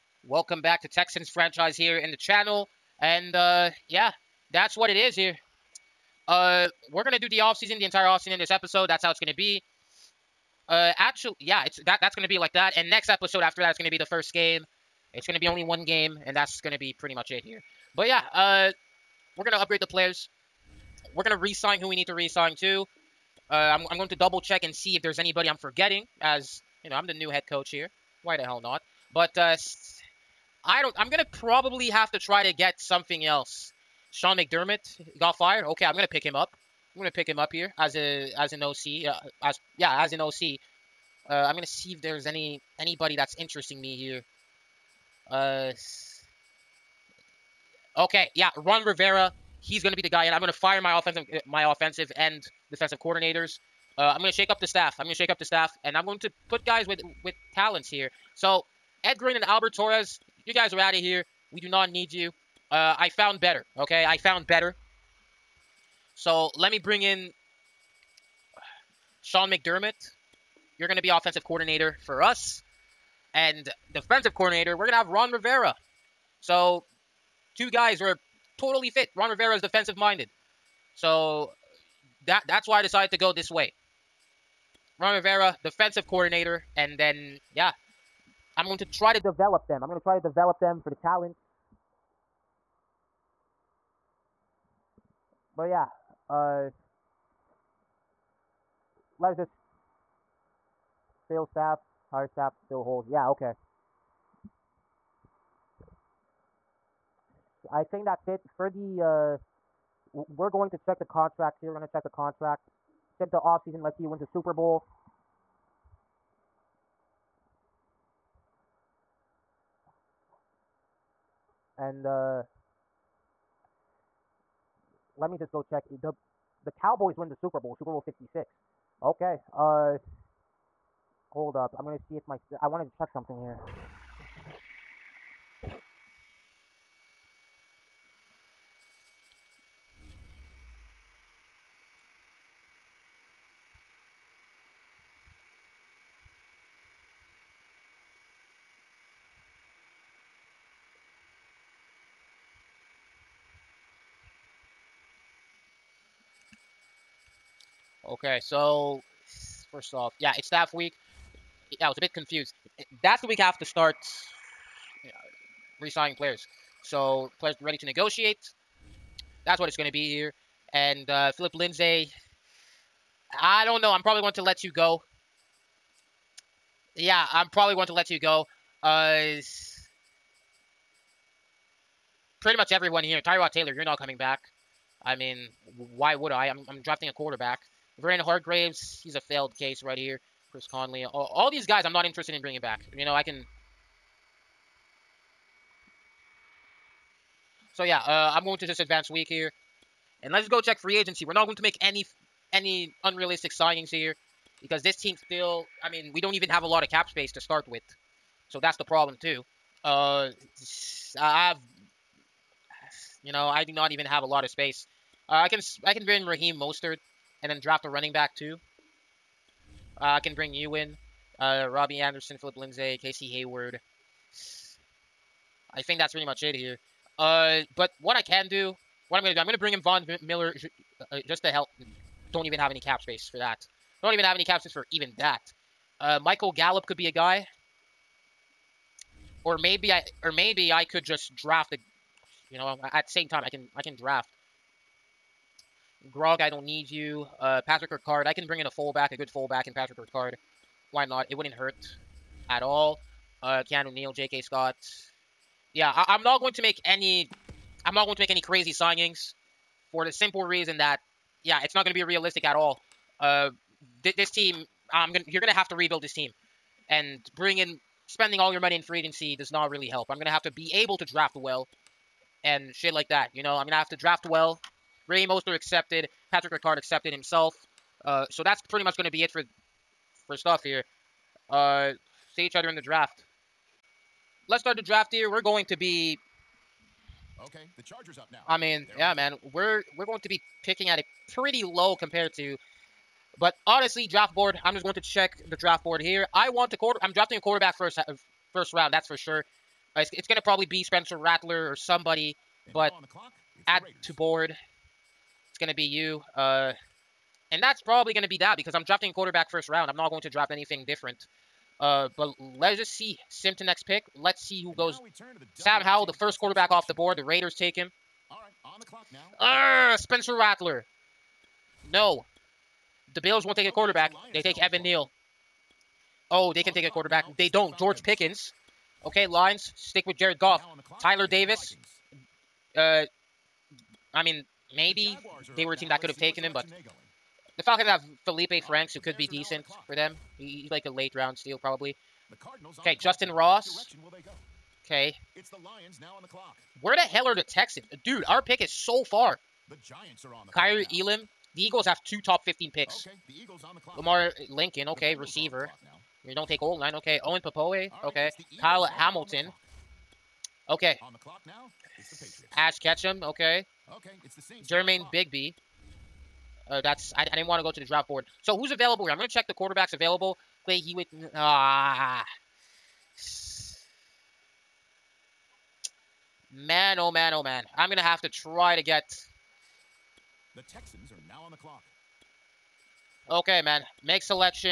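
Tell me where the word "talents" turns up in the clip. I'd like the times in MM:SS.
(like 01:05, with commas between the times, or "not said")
00:57, 01:30.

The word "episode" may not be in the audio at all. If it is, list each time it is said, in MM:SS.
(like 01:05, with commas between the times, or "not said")
00:08, 00:13.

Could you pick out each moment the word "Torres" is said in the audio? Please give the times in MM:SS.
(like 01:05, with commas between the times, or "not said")
00:59.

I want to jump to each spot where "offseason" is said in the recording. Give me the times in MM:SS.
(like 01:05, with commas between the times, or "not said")
00:07, 01:53.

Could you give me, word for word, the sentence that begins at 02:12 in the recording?
I wanted to check something here.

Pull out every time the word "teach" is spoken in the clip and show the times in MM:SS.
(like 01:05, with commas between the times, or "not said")
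not said.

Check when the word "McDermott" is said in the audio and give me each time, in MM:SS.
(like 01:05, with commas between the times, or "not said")
00:34, 01:09.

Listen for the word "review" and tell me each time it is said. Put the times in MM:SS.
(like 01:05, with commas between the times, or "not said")
not said.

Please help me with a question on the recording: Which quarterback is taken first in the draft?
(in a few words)
Sam Howell.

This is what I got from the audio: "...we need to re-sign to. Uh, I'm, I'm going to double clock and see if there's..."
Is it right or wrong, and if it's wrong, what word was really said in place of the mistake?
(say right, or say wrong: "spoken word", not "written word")
wrong: "check", not "clock".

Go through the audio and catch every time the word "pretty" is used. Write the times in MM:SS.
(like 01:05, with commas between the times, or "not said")
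00:16, 03:02, 03:46, 04:38, 04:51.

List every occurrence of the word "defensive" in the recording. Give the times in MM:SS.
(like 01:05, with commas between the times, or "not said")
00:52, 01:13, 01:19, 01:25.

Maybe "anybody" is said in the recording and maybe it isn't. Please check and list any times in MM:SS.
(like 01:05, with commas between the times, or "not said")
00:25, 00:42.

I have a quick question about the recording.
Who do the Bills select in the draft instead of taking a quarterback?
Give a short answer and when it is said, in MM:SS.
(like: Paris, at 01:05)
Evan Neal, at 05:24.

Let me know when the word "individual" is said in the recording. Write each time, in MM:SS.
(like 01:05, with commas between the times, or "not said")
not said.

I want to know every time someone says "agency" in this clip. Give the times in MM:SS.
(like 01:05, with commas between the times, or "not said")
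03:20, 04:28.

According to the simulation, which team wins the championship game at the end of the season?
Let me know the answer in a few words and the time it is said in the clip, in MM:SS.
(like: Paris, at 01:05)
Cowboys, at 02:06.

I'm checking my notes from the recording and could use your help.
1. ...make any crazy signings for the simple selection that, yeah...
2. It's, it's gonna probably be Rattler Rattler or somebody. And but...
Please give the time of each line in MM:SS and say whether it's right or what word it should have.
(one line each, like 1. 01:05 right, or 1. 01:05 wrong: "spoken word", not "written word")
1. 04:18 wrong: "reason", not "selection"
2. 04:59 wrong: "Spencer", not "Rattler".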